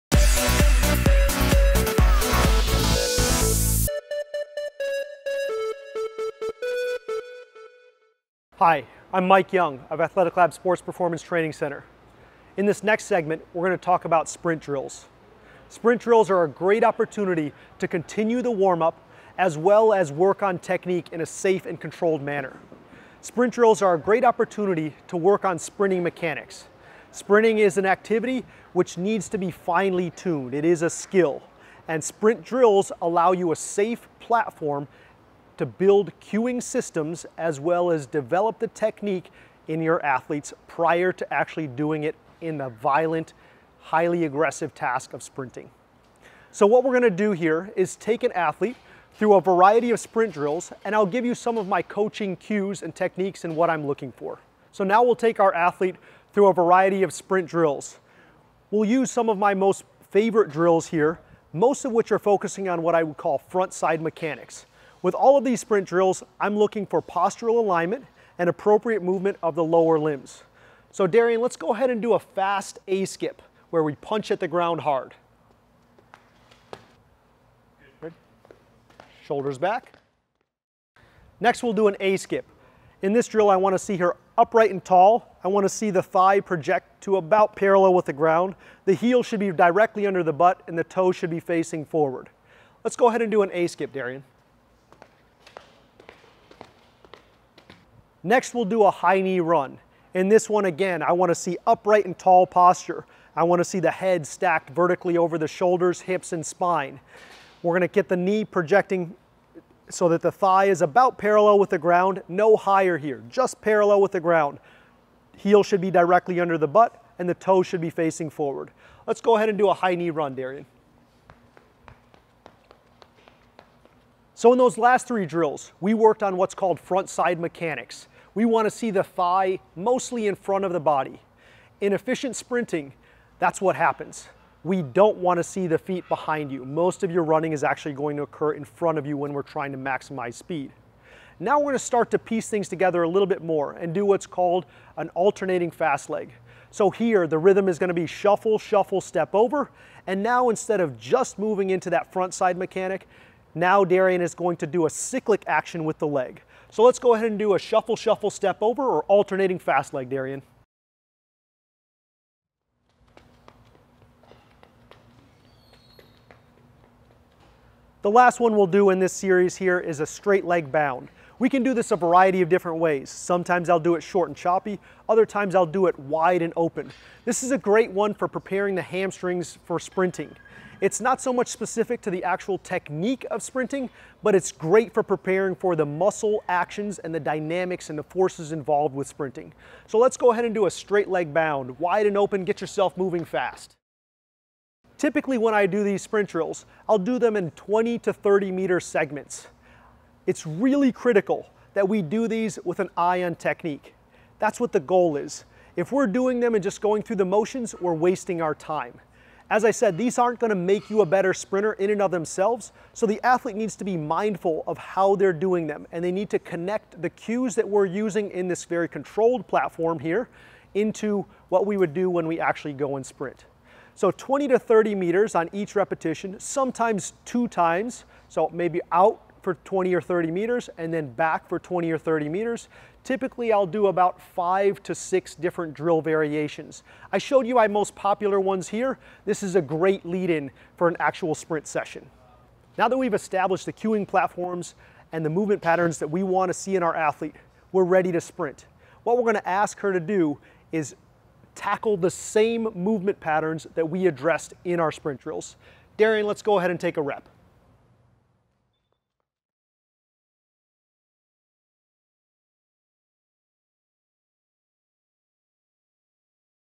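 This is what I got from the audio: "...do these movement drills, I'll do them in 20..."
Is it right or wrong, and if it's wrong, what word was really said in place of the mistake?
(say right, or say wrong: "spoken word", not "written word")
wrong: "sprint", not "movement".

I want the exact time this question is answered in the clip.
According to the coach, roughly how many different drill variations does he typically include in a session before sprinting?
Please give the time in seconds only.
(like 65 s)
234 s.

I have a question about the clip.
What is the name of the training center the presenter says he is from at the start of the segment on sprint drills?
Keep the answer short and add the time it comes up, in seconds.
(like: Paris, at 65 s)
Athletic Lab Sports Performance Training Center, at 10 s.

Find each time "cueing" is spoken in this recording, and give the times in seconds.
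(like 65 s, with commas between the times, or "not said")
36 s, 243 s.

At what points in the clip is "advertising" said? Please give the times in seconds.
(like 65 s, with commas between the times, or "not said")
not said.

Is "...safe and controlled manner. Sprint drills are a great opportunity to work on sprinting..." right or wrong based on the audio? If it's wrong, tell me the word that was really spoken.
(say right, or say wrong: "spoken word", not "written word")
right.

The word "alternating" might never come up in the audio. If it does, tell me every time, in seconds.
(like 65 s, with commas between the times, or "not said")
145 s, 159 s.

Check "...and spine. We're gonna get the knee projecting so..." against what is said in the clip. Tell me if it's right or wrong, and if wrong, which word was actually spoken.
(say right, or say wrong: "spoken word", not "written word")
right.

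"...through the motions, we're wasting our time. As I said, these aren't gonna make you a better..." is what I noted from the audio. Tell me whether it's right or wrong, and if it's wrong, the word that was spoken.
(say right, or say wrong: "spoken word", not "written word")
right.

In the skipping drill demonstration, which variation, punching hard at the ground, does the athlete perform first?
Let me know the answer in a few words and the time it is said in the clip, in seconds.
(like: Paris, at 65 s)
fast A skip, at 72 s.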